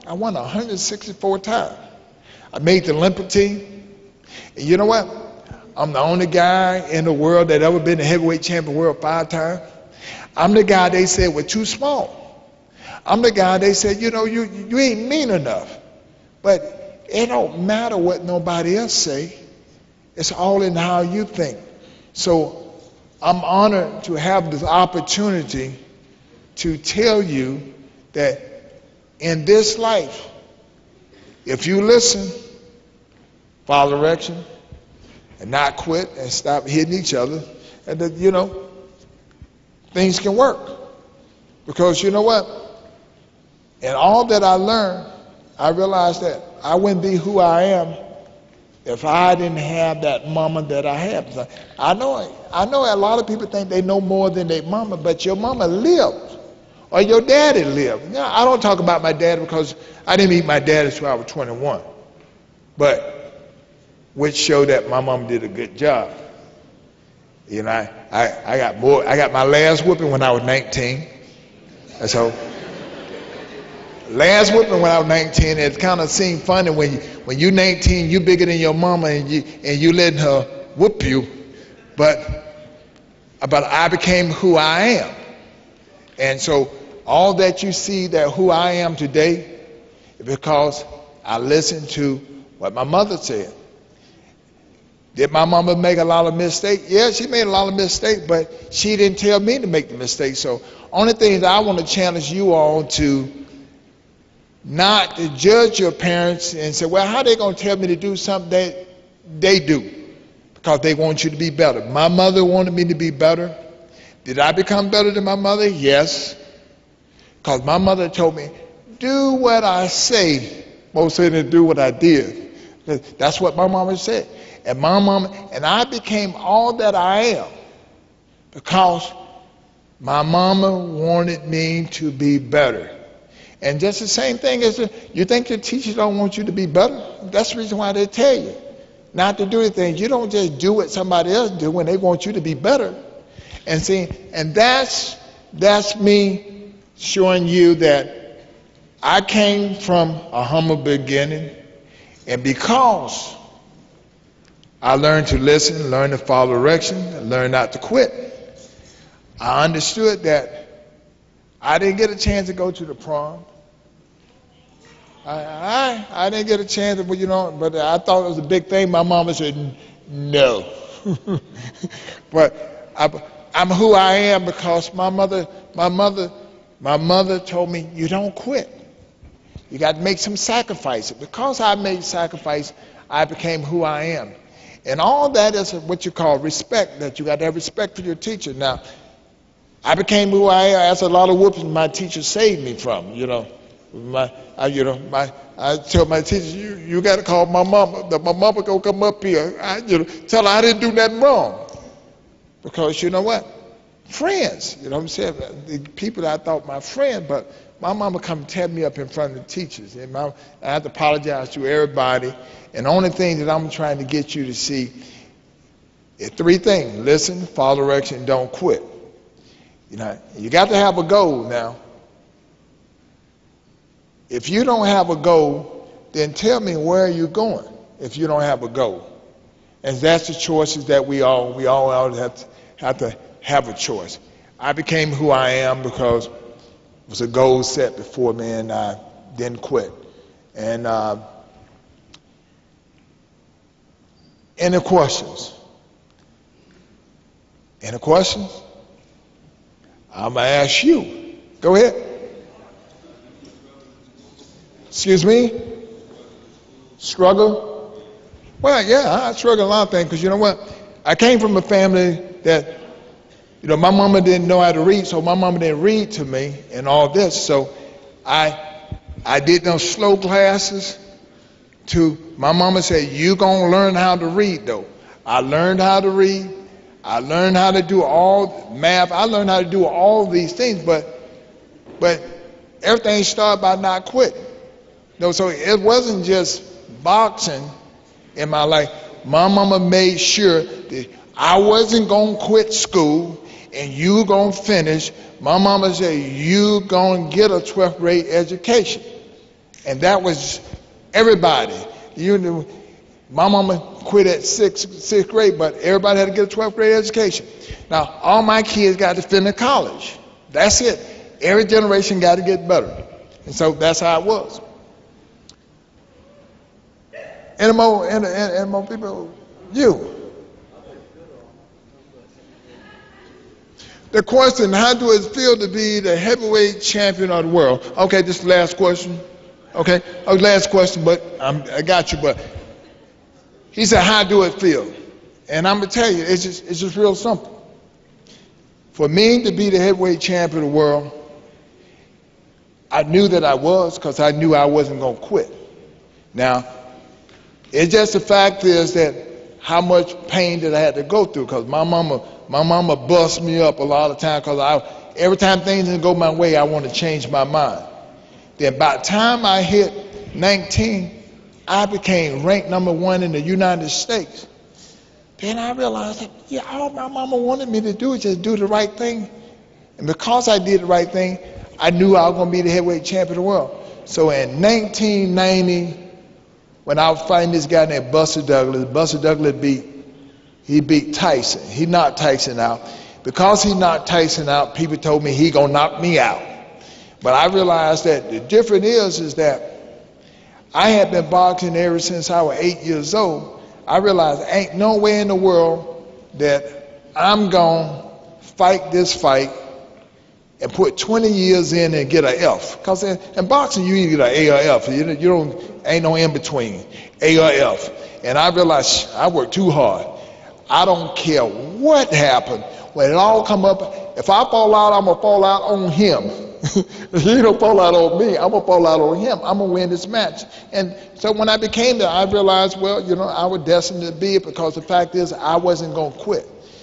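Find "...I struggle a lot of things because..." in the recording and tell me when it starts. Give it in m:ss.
4:19.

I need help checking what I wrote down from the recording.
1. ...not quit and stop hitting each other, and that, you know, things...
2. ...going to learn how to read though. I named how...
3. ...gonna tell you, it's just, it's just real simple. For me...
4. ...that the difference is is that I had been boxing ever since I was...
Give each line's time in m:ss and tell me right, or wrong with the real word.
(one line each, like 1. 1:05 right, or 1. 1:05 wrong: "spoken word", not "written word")
1. 0:35 right
2. 4:33 wrong: "learned", not "named"
3. 5:35 right
4. 6:28 right.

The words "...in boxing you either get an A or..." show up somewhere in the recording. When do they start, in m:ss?
6:43.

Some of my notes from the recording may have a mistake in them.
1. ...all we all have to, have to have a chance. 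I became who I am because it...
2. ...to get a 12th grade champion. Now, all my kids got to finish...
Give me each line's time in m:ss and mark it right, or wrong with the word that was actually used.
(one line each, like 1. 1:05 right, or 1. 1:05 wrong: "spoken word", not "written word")
1. 3:51 wrong: "choice", not "chance"
2. 5:06 wrong: "education", not "champion".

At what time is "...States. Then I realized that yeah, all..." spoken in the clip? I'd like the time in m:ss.
6:03.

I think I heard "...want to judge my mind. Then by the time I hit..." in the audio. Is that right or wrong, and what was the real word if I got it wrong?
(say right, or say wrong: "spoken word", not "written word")
wrong: "change", not "judge".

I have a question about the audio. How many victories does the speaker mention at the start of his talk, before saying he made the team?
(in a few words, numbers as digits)
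164.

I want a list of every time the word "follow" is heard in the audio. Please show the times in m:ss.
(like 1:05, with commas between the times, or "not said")
0:33, 2:36, 3:37.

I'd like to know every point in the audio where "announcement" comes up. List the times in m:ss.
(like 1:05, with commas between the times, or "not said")
not said.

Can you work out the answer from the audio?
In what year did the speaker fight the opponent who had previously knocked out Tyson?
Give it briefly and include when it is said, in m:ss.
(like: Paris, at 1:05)
1990, at 6:14.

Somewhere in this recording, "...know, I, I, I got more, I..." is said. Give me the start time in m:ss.
1:07.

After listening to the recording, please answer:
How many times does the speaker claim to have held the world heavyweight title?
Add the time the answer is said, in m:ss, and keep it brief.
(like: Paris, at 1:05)
5, at 0:09.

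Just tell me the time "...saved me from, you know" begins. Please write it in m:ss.
3:12.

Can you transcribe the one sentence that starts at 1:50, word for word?
Because they want you to be better.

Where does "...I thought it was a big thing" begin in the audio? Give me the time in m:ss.
2:47.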